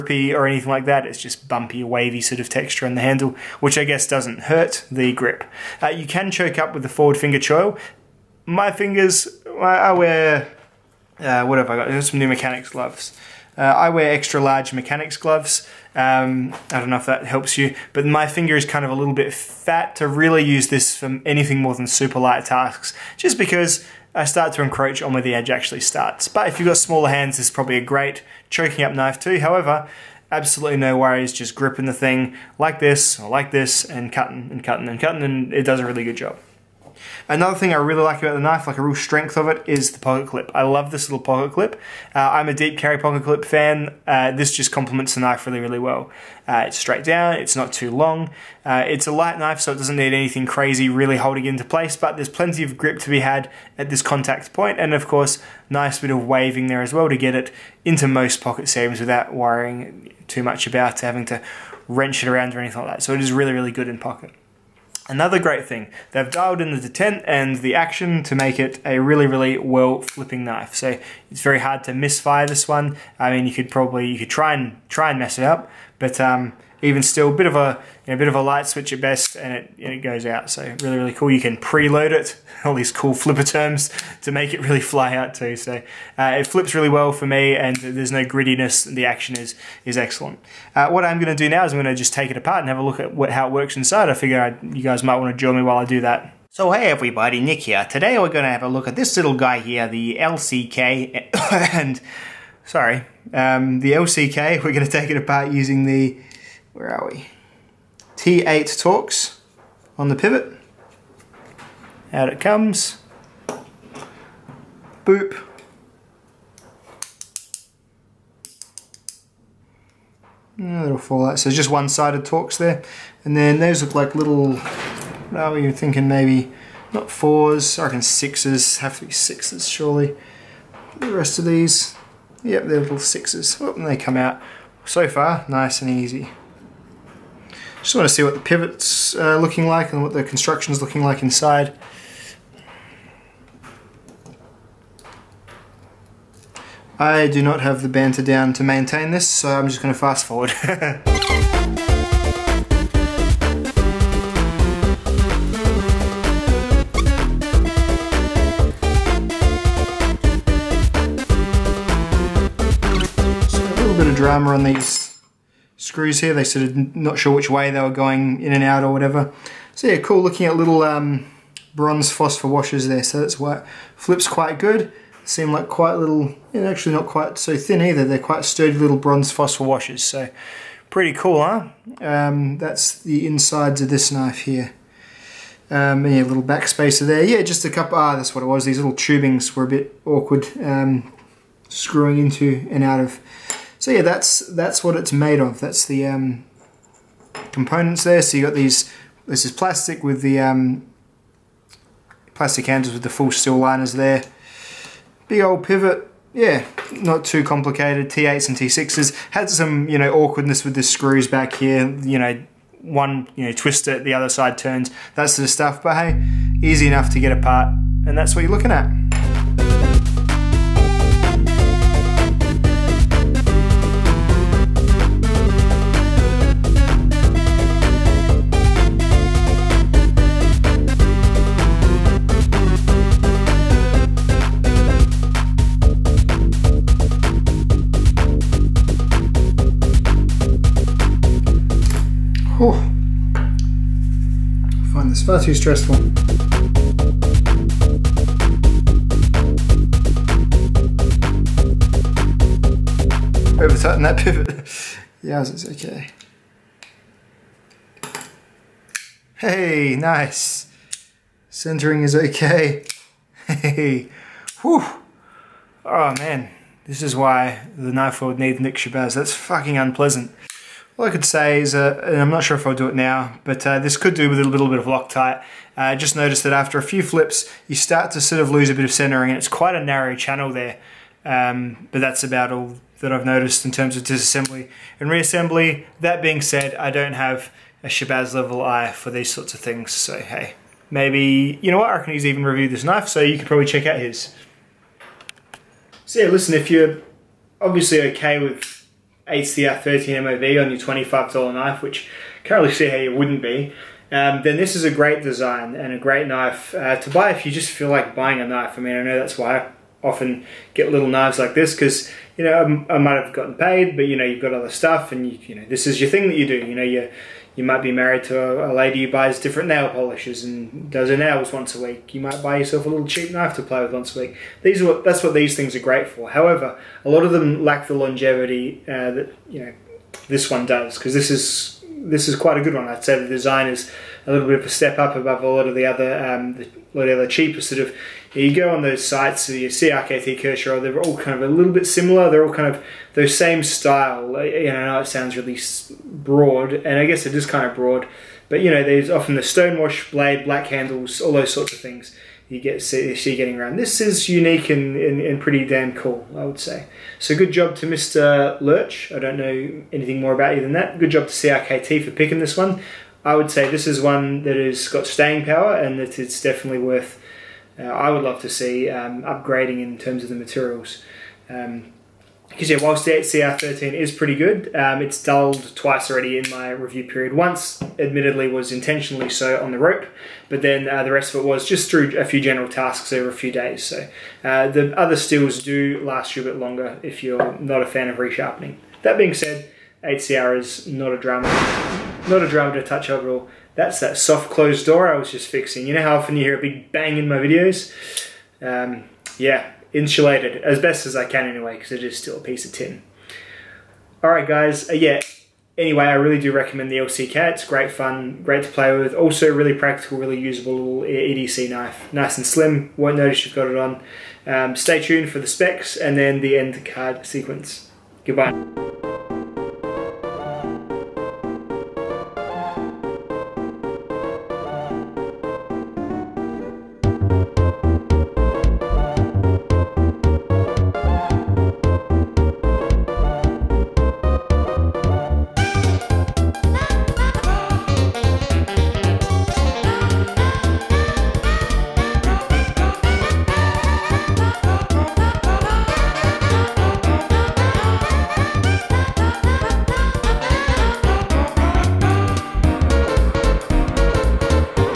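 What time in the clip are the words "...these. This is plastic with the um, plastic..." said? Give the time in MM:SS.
03:18.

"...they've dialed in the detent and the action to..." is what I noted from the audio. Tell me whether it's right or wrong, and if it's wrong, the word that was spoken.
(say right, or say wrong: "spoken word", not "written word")
right.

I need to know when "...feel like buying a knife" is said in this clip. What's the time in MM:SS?
05:07.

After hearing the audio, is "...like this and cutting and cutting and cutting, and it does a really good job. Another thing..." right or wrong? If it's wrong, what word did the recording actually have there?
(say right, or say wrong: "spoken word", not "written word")
right.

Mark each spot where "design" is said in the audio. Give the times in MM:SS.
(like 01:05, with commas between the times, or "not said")
05:05, 05:33.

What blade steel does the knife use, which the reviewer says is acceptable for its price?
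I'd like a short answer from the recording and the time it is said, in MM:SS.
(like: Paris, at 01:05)
8CR13MOV, at 04:59.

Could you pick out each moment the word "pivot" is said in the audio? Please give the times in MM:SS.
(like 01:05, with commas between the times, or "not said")
01:50, 02:18, 03:25, 04:14.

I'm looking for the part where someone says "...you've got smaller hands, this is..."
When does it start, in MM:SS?
00:26.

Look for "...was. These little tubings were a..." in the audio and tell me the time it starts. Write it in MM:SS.
03:08.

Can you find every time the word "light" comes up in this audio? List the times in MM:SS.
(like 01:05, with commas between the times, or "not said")
00:22, 00:49, 01:18.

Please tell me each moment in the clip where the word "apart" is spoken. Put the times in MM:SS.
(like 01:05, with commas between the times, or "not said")
01:32, 01:45, 03:37.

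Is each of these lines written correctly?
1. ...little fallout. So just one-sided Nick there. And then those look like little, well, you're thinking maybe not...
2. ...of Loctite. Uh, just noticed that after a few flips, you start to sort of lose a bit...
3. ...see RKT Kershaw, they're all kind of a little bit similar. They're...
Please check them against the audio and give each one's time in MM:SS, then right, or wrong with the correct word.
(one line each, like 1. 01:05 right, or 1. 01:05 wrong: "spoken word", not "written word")
1. 02:00 wrong: "Torx", not "Nick"
2. 04:34 right
3. 05:39 right.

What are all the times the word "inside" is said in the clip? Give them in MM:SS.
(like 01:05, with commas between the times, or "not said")
01:33, 02:21, 03:03.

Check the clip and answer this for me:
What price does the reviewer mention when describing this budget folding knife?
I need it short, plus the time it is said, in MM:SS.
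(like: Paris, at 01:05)
$25, at 05:00.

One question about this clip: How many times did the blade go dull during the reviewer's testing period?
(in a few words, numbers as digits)
2.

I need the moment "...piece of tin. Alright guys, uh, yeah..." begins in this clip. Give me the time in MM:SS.
06:42.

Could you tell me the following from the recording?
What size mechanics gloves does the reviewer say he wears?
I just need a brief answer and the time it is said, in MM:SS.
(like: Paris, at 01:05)
Extra large, at 00:14.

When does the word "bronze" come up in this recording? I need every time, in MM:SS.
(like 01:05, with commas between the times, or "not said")
02:51, 02:58.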